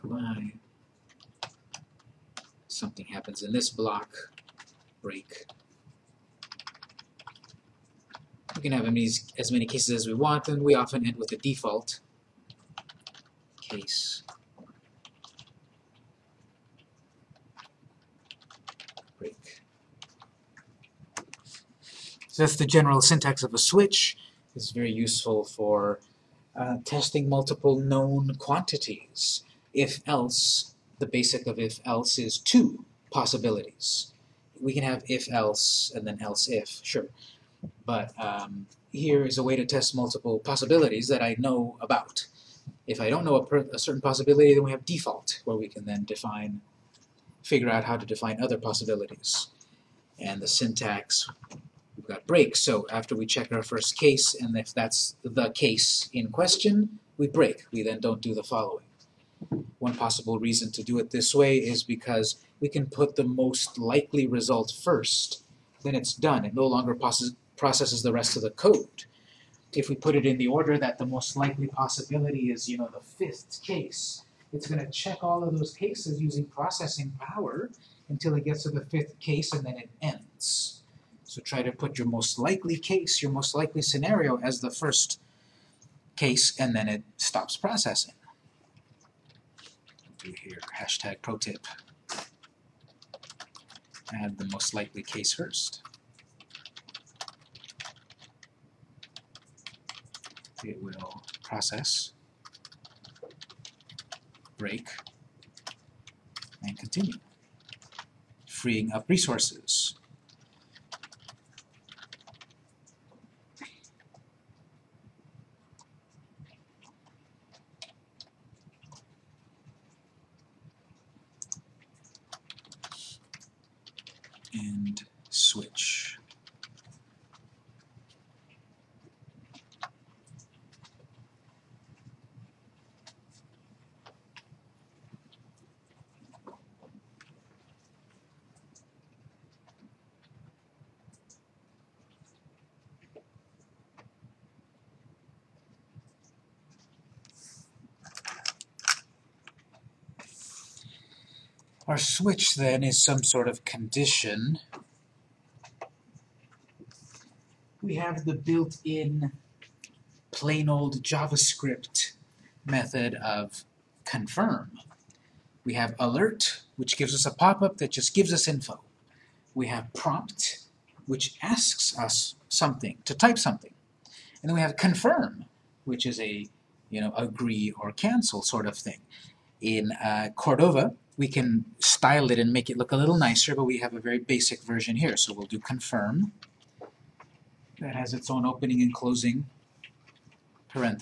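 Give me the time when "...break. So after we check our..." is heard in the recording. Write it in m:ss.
0:52.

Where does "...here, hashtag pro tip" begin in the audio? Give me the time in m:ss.
1:30.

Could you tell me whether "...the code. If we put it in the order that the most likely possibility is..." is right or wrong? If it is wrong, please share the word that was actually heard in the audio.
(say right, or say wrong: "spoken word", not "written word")
right.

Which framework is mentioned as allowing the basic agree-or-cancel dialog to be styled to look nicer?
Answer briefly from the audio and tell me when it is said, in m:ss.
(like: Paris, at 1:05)
Cordova, at 3:00.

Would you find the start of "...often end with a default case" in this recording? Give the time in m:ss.
0:10.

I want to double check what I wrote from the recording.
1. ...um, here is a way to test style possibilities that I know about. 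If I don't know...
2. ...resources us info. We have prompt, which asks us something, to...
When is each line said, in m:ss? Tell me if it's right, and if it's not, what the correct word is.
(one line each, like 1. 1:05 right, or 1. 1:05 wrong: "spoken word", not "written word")
1. 0:38 wrong: "multiple", not "style"
2. 2:48 wrong: "gives", not "resources".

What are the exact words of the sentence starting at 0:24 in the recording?
It's very useful for uh, testing multiple known quantities.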